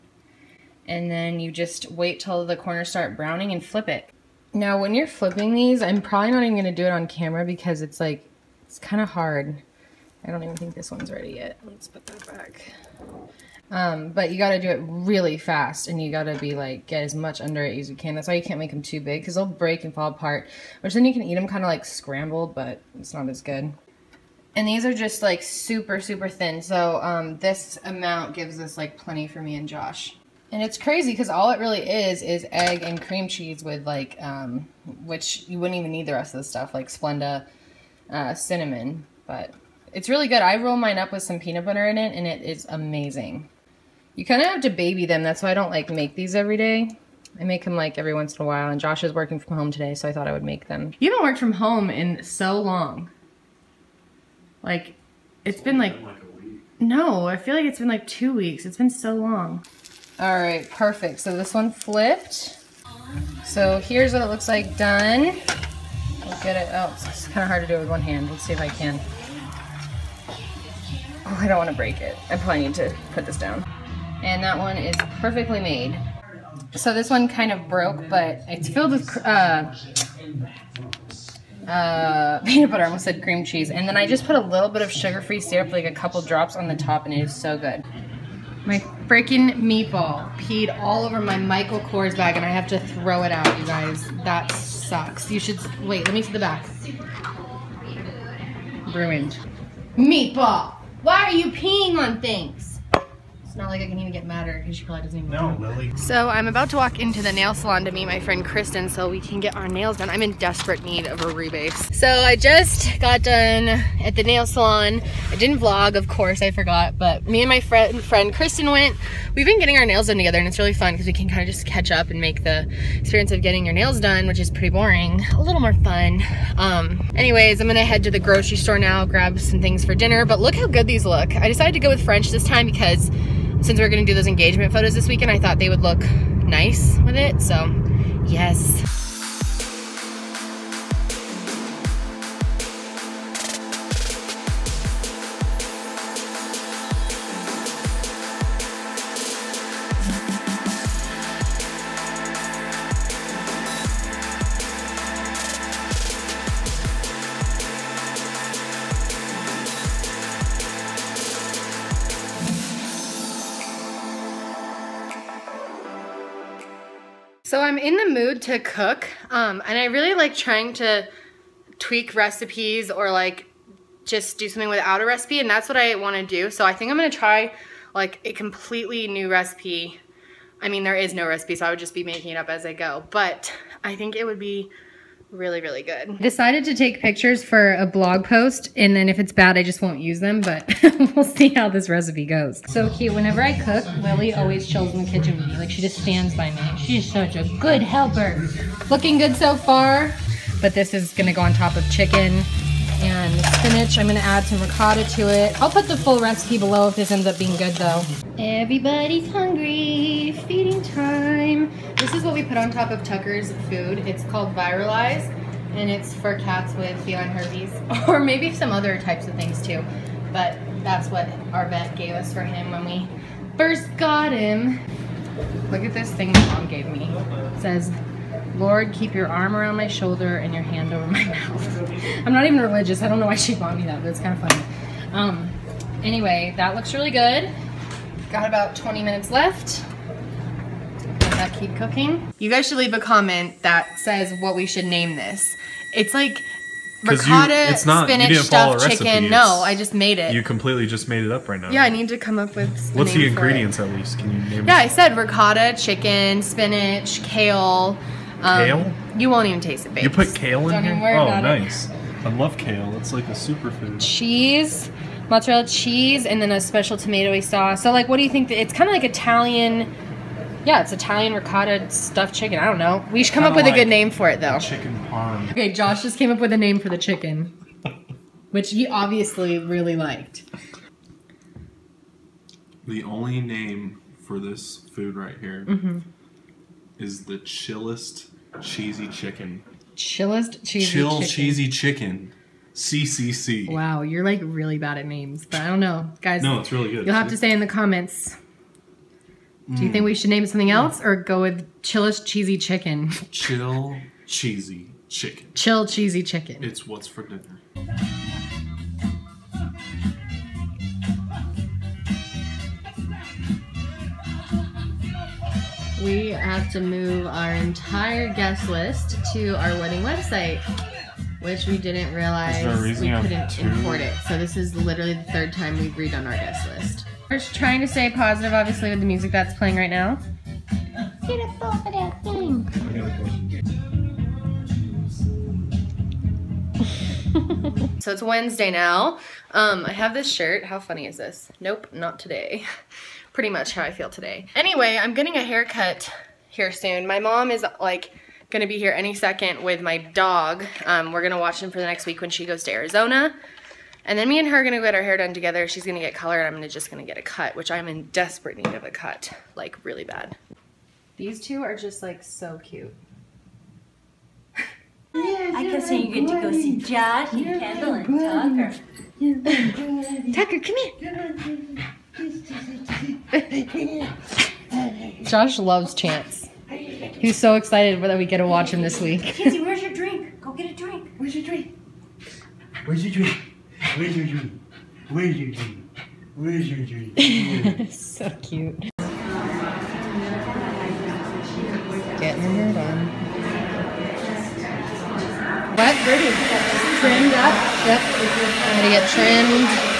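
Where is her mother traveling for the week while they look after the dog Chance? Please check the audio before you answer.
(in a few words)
Arizona.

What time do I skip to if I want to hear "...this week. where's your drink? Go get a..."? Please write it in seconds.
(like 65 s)
378 s.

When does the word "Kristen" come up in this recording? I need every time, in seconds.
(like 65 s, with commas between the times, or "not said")
108 s, 118 s.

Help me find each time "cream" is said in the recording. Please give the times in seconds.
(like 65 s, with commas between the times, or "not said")
32 s, 83 s.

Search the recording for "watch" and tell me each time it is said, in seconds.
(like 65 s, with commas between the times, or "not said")
351 s, 378 s.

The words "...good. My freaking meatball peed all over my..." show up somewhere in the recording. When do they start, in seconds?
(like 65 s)
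87 s.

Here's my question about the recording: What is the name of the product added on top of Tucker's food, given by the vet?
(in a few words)
Viralys.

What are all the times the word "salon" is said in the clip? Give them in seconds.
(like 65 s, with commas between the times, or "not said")
107 s, 114 s.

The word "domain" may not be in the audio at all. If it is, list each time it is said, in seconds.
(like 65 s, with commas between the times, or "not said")
not said.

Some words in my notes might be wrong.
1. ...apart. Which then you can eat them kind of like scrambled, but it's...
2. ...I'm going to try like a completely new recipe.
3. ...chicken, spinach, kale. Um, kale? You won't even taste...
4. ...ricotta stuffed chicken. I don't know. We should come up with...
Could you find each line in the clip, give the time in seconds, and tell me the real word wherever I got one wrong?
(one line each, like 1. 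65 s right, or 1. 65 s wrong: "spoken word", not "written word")
1. 20 s right
2. 176 s right
3. 255 s right
4. 271 s right.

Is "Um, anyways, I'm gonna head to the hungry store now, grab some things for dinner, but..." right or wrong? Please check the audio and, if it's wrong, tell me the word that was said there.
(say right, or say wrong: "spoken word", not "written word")
wrong: "grocery", not "hungry".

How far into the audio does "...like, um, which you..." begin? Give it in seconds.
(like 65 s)
33 s.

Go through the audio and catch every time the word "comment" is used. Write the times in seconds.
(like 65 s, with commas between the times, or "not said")
242 s, 297 s.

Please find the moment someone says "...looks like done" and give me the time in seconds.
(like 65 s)
64 s.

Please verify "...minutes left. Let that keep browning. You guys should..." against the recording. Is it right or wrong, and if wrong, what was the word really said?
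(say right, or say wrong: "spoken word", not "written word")
wrong: "cooking", not "browning".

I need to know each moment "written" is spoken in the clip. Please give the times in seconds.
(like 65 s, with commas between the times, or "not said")
not said.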